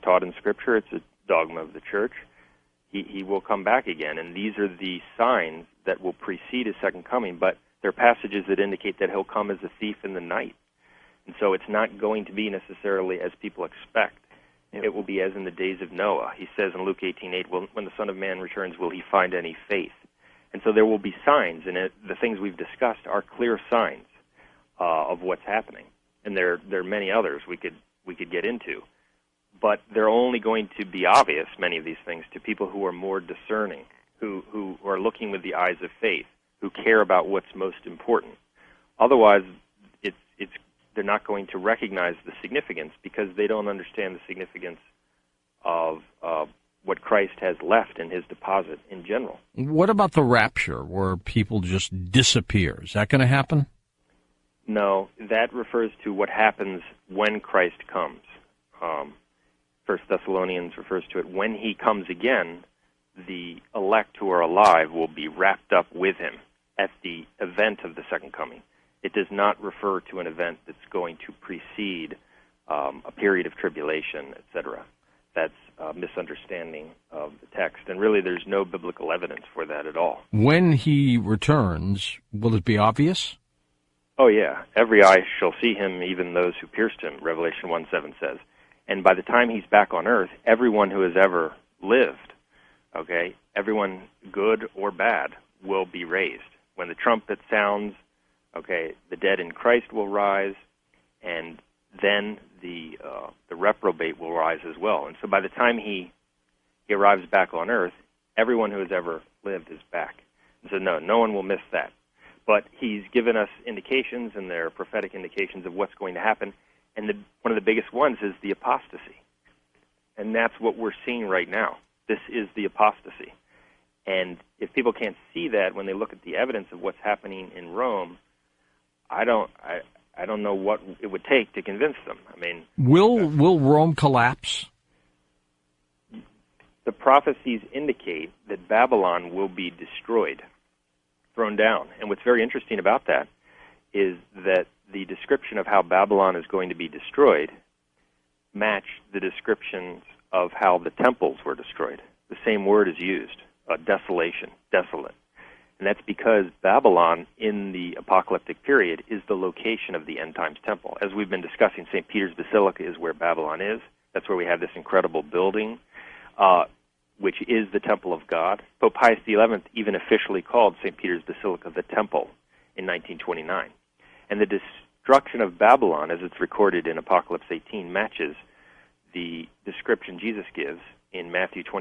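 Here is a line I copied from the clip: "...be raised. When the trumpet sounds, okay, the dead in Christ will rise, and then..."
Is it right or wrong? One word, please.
right.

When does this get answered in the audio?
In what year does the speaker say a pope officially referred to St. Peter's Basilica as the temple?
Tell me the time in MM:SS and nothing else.
02:52.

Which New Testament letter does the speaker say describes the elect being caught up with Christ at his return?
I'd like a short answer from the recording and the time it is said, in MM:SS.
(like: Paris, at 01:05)
First Thessalonians, at 00:59.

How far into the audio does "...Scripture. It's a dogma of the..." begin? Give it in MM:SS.
00:00.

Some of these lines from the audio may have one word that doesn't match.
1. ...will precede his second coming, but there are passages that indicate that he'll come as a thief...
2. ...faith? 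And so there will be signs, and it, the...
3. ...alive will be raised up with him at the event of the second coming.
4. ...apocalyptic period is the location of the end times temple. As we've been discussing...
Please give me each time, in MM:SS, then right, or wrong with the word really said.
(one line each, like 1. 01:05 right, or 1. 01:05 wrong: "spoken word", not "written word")
1. 00:06 right
2. 00:19 right
3. 01:04 wrong: "wrapped", not "raised"
4. 02:37 right.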